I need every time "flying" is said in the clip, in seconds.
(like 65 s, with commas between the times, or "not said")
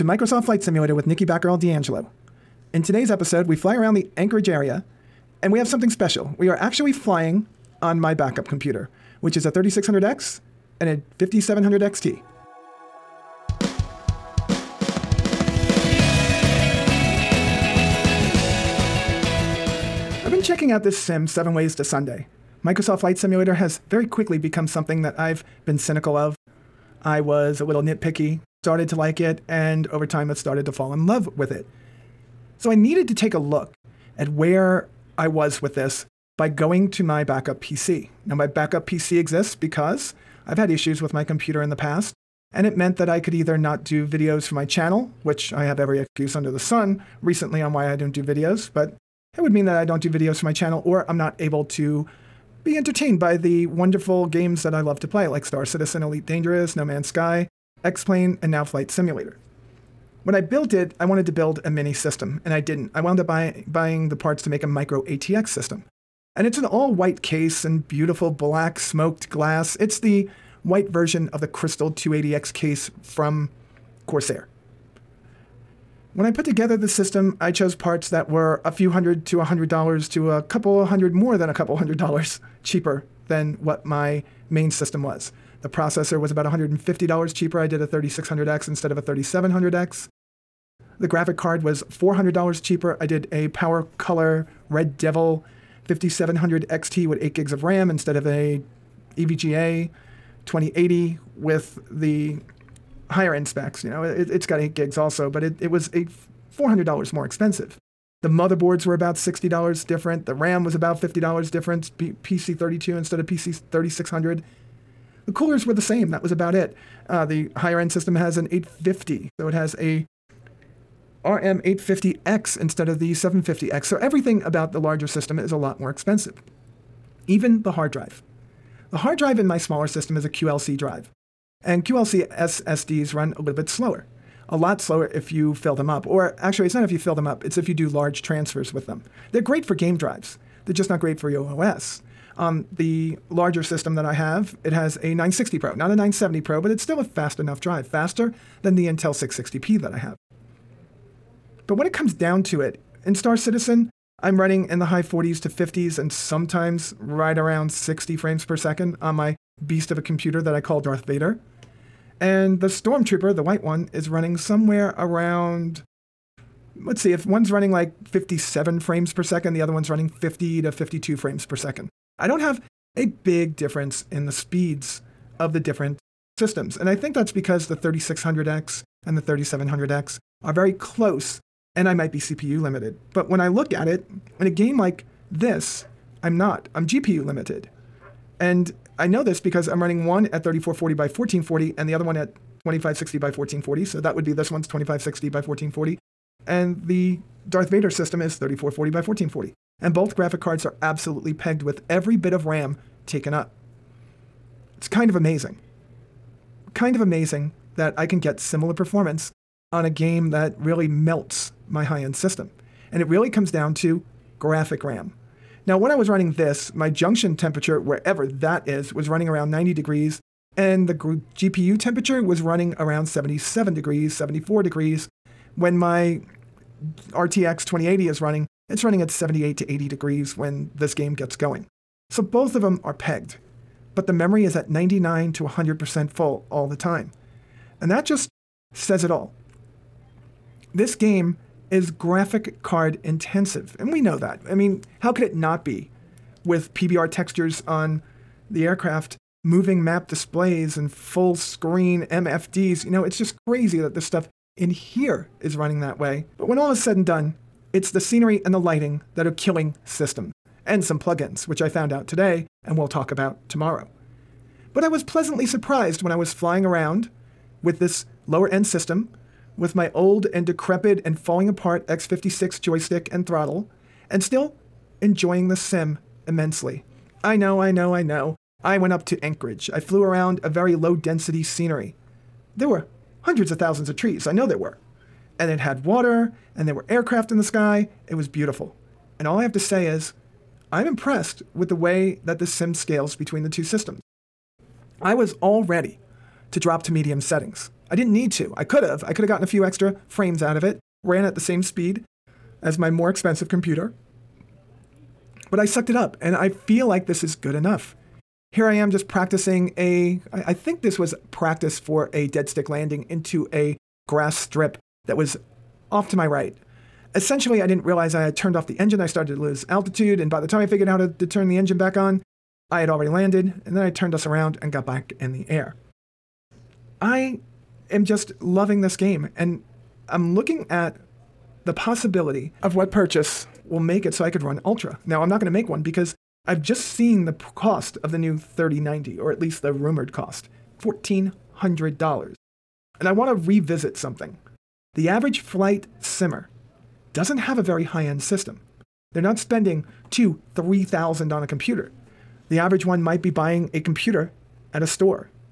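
6 s, 266 s.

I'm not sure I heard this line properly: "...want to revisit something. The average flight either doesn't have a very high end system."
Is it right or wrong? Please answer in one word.
wrong.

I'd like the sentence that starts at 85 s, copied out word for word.
The processor was about $150 cheaper.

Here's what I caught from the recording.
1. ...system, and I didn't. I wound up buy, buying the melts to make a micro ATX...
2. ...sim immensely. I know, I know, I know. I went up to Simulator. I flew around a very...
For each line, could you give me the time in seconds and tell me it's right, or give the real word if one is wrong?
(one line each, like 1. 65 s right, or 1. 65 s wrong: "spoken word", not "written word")
1. 61 s wrong: "parts", not "melts"
2. 275 s wrong: "Anchorage", not "Simulator".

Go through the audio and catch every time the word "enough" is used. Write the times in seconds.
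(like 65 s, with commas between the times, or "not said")
147 s, 307 s.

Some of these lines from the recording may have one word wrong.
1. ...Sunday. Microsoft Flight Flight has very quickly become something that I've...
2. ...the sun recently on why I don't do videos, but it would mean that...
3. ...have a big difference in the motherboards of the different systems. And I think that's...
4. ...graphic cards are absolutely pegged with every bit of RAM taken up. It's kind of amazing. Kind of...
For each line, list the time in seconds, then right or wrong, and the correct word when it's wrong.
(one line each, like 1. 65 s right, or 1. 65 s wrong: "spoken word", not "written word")
1. 21 s wrong: "Simulator", not "Flight"
2. 46 s right
3. 172 s wrong: "speeds", not "motherboards"
4. 200 s right.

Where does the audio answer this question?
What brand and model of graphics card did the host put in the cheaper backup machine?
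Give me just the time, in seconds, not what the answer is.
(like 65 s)
93 s.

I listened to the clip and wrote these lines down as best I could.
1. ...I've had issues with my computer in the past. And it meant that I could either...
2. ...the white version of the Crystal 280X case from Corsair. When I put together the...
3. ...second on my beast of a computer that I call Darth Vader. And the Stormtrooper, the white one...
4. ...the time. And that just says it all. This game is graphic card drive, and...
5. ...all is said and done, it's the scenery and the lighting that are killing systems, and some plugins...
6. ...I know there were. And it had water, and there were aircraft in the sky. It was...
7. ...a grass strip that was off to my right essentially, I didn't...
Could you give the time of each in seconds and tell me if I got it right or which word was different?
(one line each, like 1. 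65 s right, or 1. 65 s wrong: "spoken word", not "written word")
1. 40 s right
2. 69 s right
3. 158 s right
4. 236 s wrong: "intensive", not "drive"
5. 256 s right
6. 284 s right
7. 313 s right.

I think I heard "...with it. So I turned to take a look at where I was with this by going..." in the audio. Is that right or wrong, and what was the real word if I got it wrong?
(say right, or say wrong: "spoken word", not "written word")
wrong: "needed", not "turned".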